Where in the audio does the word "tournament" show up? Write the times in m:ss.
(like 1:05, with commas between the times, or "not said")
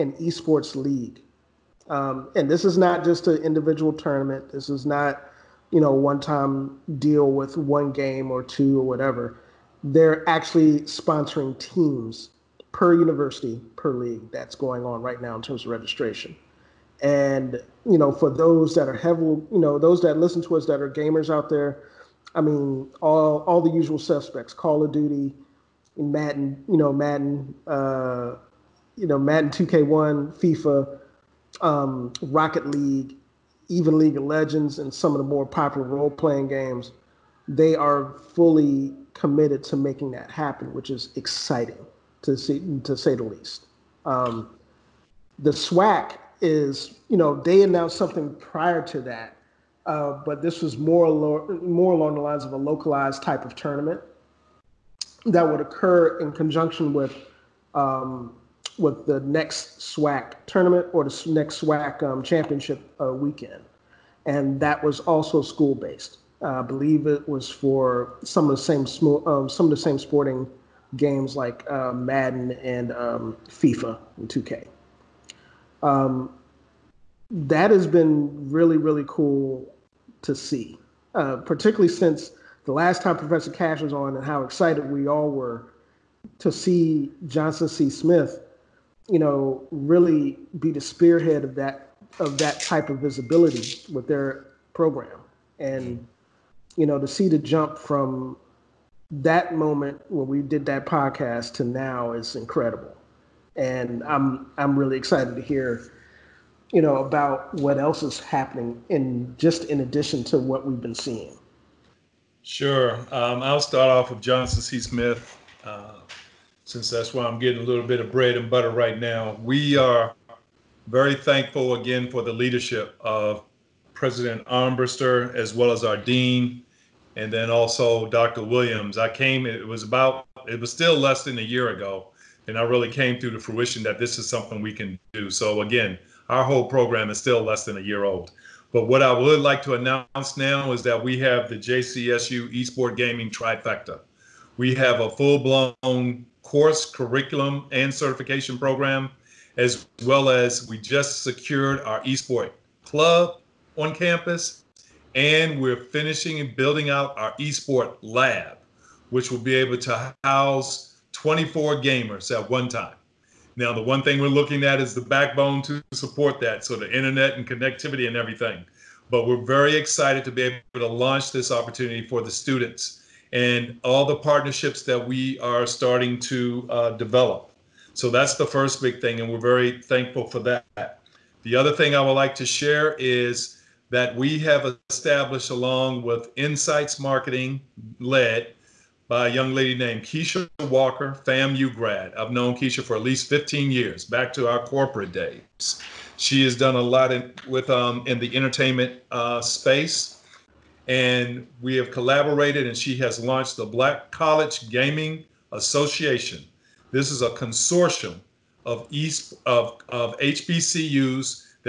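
0:03, 0:53, 1:00.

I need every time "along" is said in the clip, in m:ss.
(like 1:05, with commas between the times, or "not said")
0:51, 3:05.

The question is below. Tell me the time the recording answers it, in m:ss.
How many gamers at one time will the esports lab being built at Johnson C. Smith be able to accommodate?
2:41.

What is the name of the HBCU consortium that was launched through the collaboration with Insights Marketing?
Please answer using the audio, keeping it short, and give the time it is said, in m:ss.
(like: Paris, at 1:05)
Black College Gaming Association, at 3:23.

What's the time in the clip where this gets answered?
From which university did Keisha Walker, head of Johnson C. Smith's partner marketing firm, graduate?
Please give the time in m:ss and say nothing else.
3:11.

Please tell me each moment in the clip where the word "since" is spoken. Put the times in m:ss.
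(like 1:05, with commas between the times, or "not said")
1:21, 1:56.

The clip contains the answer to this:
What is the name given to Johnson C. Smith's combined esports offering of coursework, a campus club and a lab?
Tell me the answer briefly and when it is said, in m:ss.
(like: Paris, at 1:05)
JCSU Esport Gaming Trifecta, at 2:21.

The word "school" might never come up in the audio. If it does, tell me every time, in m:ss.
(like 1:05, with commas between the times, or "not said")
1:05.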